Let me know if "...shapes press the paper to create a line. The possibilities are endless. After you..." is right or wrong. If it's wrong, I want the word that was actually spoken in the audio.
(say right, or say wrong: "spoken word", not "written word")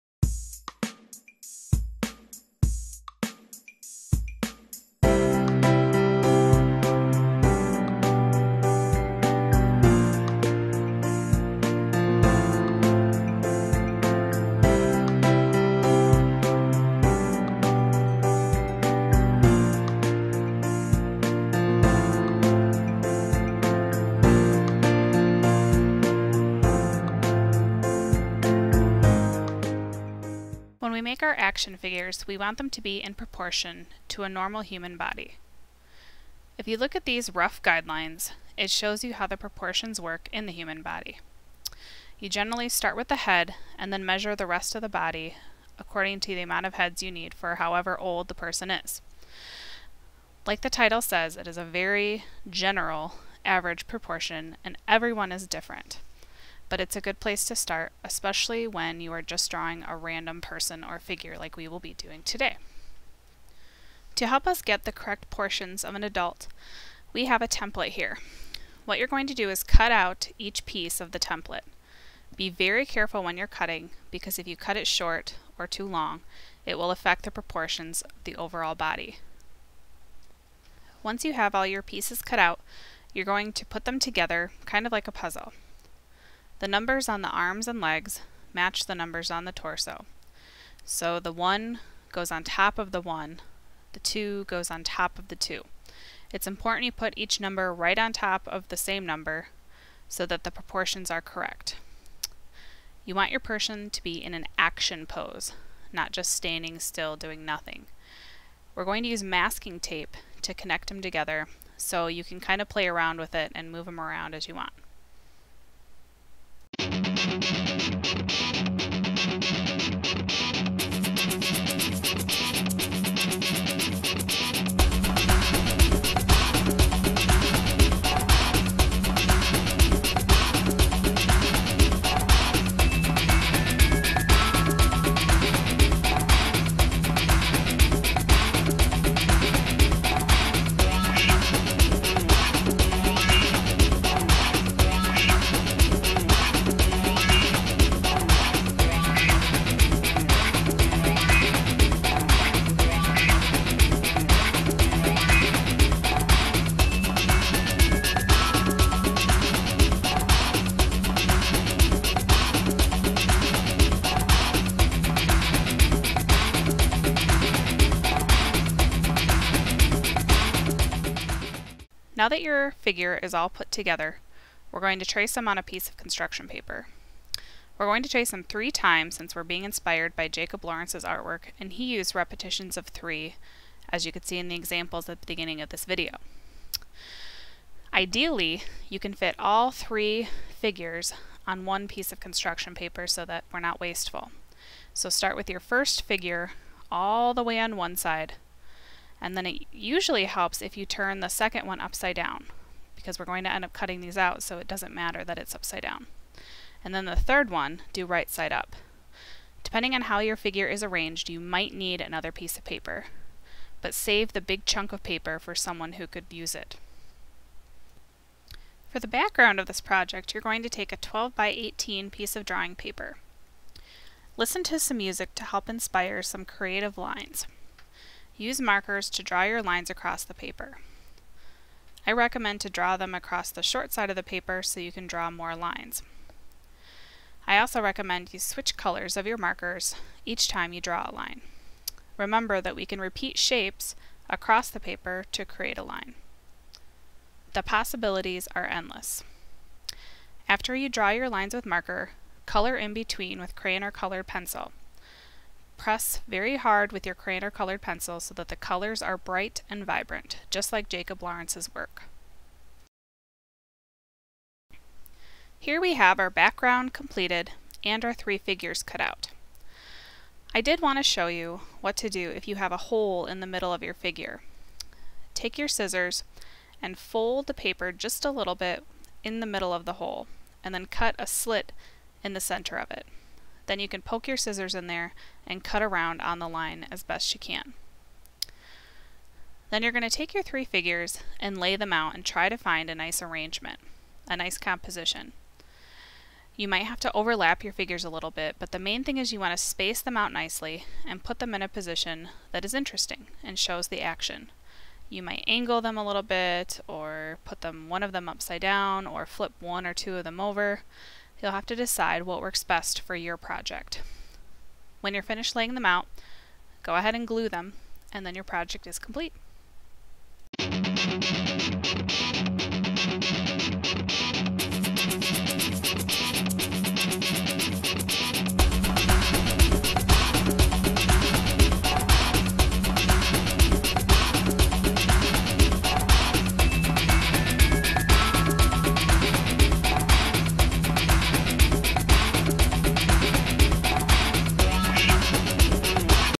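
wrong: "across", not "press".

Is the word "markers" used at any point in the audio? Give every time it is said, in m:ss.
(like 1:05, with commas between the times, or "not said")
3:48, 3:59, 4:11.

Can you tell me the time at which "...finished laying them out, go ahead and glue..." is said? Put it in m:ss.
5:15.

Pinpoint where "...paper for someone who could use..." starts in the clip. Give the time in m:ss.
3:35.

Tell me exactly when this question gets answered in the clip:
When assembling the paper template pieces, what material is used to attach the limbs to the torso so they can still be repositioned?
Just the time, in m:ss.
1:49.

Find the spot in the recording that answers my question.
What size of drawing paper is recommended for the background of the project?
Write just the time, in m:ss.
3:40.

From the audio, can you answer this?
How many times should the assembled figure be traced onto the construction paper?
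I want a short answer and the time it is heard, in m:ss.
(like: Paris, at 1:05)
3, at 2:58.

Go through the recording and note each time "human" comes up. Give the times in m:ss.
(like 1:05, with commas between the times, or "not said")
0:34, 0:40.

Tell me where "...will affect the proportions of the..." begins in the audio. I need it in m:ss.
1:16.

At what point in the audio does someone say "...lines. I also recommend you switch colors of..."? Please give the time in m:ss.
3:55.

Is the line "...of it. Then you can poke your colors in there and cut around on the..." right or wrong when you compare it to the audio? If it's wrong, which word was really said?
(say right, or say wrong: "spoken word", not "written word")
wrong: "scissors", not "colors".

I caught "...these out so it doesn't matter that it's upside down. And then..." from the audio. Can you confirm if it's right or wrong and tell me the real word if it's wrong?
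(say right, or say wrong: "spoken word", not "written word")
right.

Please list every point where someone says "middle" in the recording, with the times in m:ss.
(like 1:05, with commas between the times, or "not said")
4:33, 4:39.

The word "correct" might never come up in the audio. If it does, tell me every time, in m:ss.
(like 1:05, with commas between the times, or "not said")
1:04, 1:41.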